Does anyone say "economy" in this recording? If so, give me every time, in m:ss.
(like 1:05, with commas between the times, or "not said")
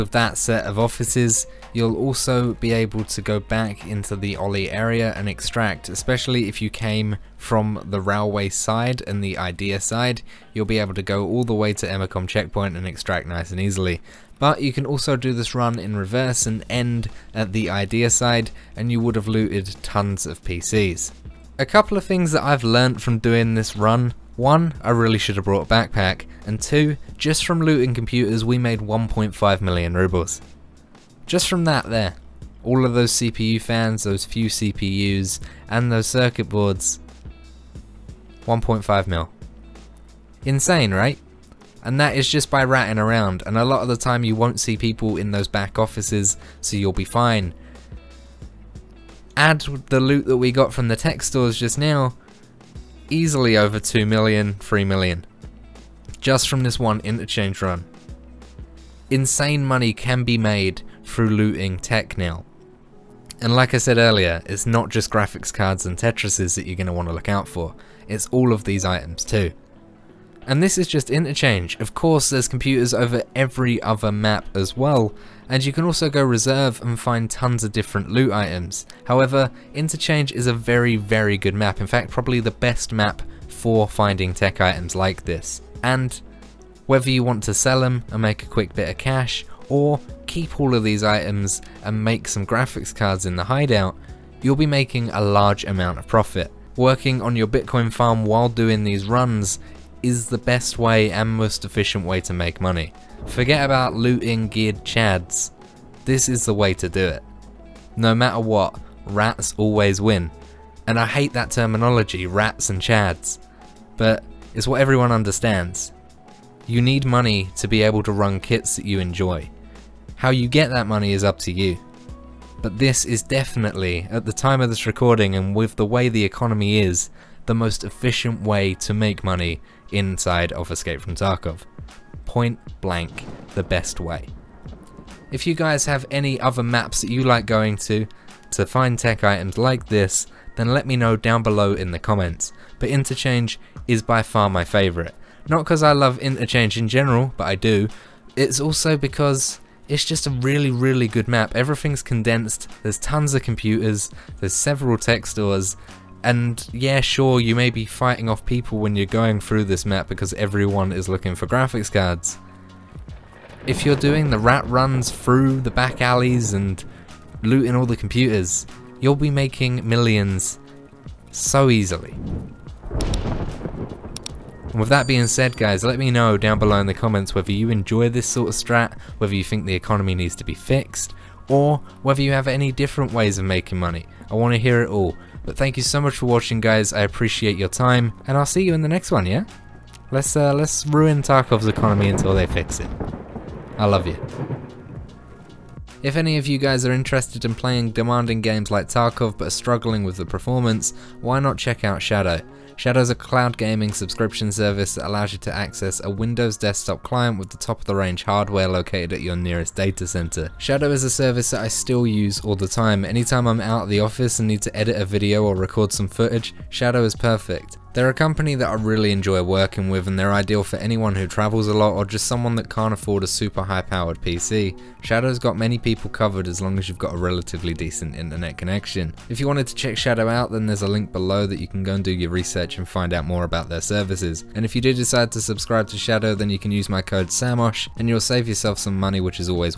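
2:06, 2:59, 3:11.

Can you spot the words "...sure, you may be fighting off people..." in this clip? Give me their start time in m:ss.
2:37.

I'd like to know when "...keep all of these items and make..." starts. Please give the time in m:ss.
1:30.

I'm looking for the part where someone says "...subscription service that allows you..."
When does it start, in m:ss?
3:23.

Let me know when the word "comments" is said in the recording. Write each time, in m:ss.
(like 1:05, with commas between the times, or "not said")
2:21, 2:56.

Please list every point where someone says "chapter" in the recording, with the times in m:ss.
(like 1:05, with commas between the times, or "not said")
not said.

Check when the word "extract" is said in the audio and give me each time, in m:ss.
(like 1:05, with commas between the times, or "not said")
0:05, 0:12.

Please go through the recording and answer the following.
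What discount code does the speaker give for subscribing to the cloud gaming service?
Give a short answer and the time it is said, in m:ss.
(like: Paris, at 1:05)
SAMOSH, at 3:57.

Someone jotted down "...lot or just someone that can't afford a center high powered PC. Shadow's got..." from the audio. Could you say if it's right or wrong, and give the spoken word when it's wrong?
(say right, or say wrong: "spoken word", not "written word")
wrong: "super", not "center".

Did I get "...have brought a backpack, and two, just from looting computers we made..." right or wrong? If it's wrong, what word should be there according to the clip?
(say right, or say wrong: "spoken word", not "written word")
right.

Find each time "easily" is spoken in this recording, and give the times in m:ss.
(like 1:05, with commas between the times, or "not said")
0:13, 0:53, 2:51.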